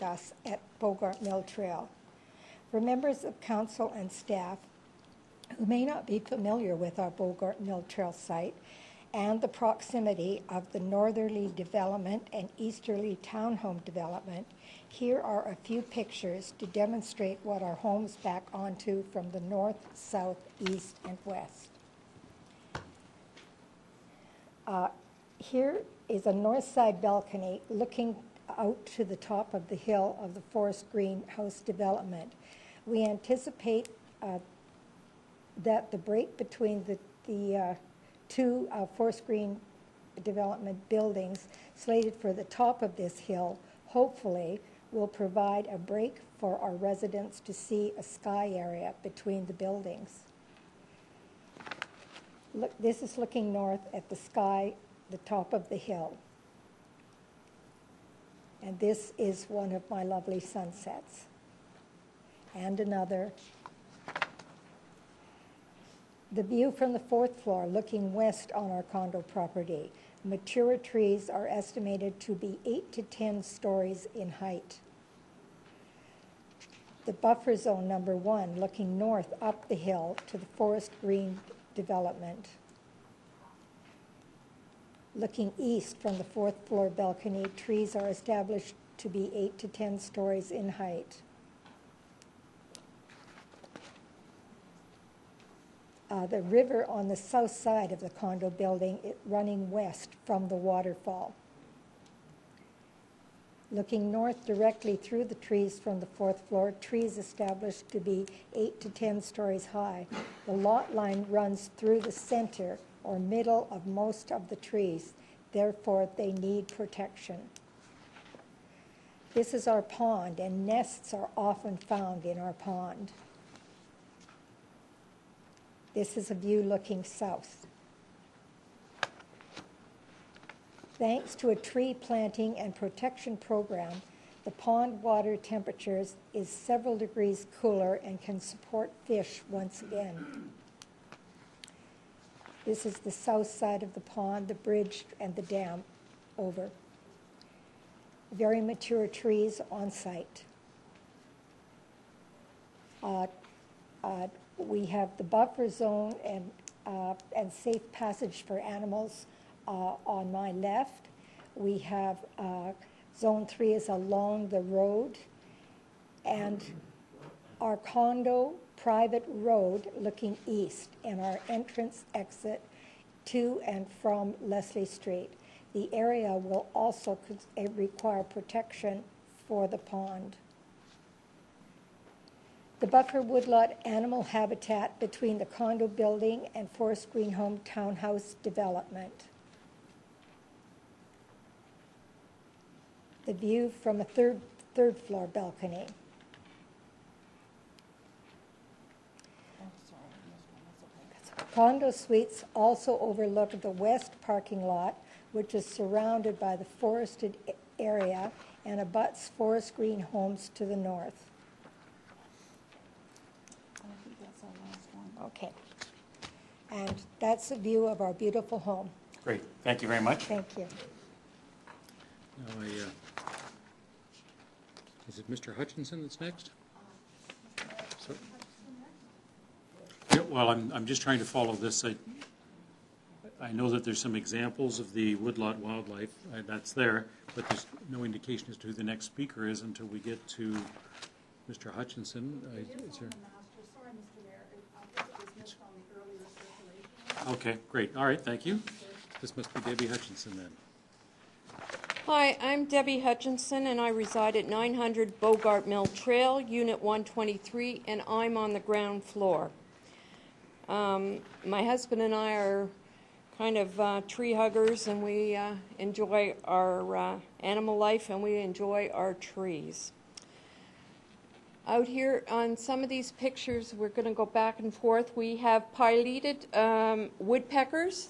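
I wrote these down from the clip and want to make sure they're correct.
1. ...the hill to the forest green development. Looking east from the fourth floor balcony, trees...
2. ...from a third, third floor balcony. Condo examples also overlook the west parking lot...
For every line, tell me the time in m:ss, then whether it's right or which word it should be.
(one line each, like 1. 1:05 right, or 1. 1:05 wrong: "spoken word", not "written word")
1. 1:19 right
2. 3:13 wrong: "suites", not "examples".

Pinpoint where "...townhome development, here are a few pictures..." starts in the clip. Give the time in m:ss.
0:13.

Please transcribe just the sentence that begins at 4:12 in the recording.
Hi, I'm Debbie Hutchinson, and I reside at 900 Bogart Mill Trail, Unit 123, and I'm on the ground floor.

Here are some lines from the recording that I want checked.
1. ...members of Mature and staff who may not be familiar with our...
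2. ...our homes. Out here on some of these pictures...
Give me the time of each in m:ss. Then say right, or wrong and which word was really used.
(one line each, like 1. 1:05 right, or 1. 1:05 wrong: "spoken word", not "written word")
1. 0:02 wrong: "Council", not "Mature"
2. 4:28 wrong: "trees", not "homes".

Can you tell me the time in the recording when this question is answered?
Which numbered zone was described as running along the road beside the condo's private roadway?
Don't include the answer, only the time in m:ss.
2:43.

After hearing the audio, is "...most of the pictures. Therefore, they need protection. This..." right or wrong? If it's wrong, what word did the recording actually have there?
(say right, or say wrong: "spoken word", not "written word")
wrong: "trees", not "pictures".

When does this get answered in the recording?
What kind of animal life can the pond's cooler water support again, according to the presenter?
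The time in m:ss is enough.
2:19.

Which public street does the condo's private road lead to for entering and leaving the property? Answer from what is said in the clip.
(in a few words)
Leslie Street.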